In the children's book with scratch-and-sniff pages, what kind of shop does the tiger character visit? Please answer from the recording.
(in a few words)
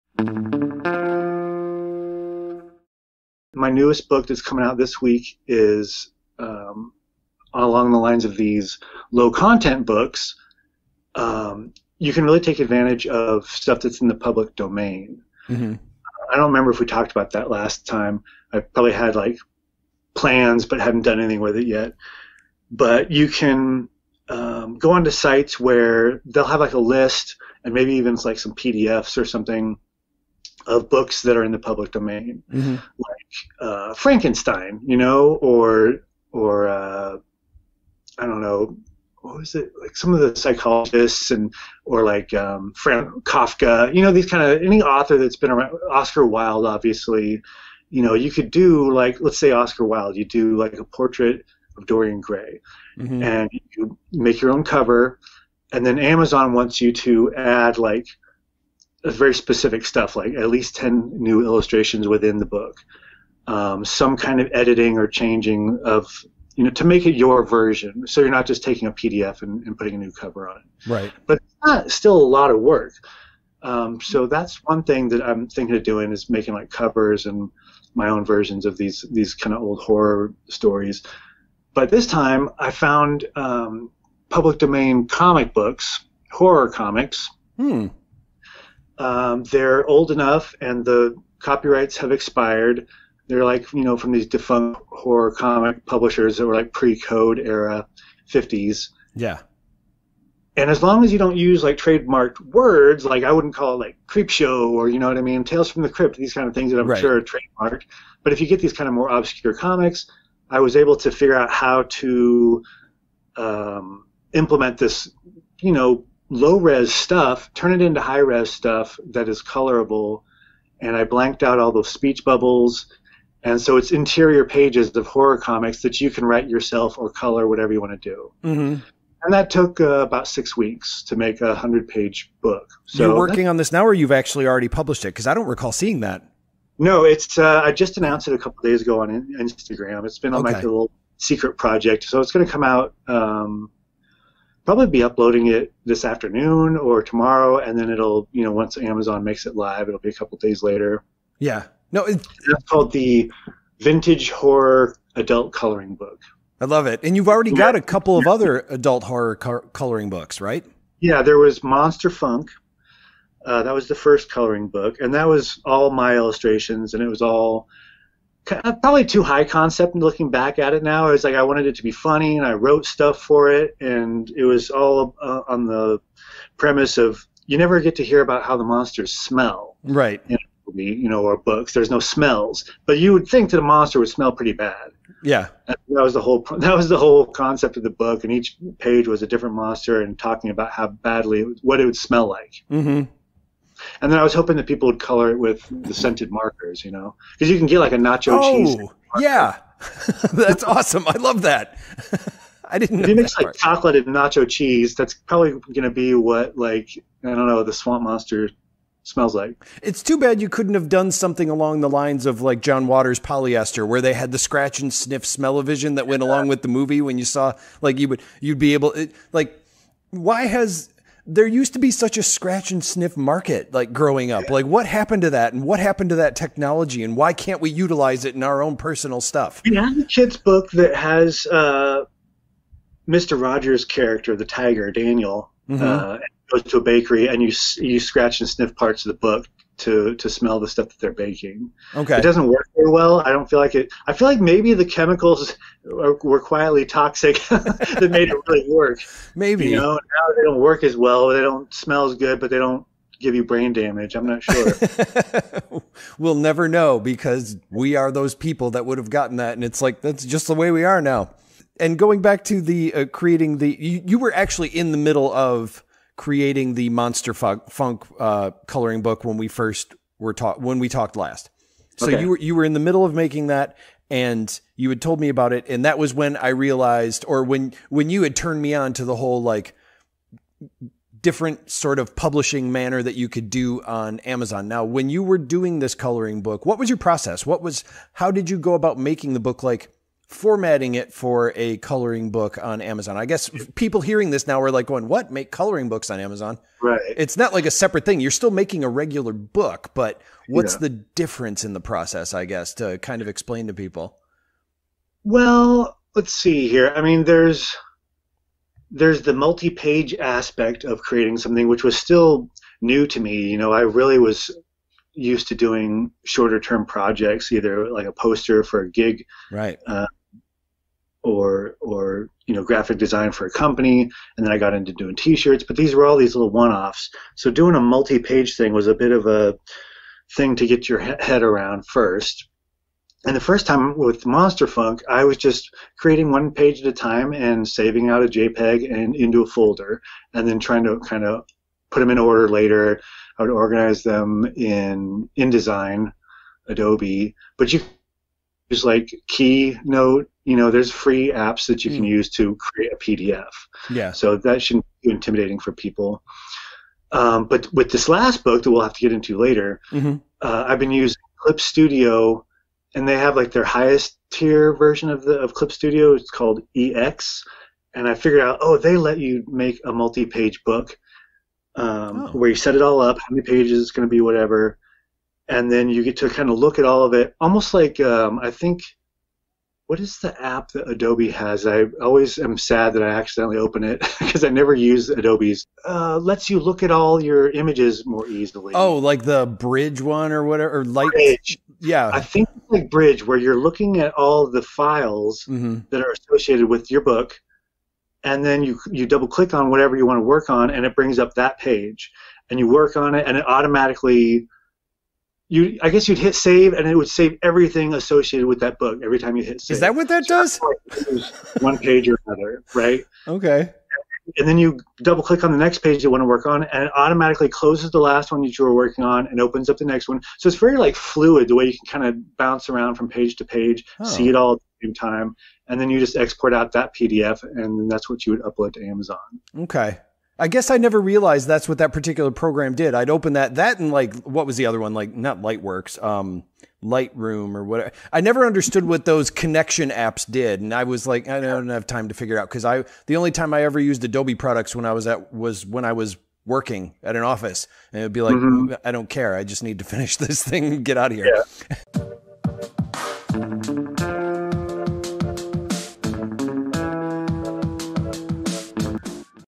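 a bakery.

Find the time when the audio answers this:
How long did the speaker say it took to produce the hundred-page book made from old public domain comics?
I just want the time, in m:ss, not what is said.
2:09.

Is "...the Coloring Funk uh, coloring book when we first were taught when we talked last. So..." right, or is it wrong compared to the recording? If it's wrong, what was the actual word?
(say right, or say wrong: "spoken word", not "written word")
wrong: "Monster", not "Coloring".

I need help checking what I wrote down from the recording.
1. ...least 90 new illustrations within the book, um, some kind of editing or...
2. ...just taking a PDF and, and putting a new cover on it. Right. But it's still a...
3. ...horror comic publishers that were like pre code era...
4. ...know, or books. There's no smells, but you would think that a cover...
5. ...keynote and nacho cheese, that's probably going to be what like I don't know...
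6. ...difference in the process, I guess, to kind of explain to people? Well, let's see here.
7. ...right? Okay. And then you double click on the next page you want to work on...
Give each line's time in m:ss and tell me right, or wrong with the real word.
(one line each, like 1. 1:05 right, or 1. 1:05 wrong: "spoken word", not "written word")
1. 1:00 wrong: "10", not "90"
2. 1:08 right
3. 1:34 right
4. 3:01 wrong: "monster", not "cover"
5. 3:23 wrong: "chocolate", not "keynote"
6. 5:00 right
7. 6:52 right.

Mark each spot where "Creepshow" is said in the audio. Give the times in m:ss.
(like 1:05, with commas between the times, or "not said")
1:44.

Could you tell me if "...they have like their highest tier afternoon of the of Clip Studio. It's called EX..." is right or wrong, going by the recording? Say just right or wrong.
wrong.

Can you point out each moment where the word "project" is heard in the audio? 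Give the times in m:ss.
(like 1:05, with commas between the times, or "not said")
2:21, 5:16.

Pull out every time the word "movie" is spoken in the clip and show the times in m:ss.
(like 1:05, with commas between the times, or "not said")
3:00, 3:36.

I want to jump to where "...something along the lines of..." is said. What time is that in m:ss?
3:31.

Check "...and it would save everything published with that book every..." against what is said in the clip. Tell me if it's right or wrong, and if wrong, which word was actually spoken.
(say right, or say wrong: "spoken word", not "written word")
wrong: "associated", not "published".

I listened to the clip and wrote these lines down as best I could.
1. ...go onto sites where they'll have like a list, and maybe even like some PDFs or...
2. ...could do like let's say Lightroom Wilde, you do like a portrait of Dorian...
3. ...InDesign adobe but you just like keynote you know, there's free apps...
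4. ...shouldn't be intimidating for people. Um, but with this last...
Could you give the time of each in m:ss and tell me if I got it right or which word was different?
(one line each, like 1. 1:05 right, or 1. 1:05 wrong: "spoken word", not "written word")
1. 0:24 right
2. 0:48 wrong: "Oscar", not "Lightroom"
3. 5:45 right
4. 5:54 right.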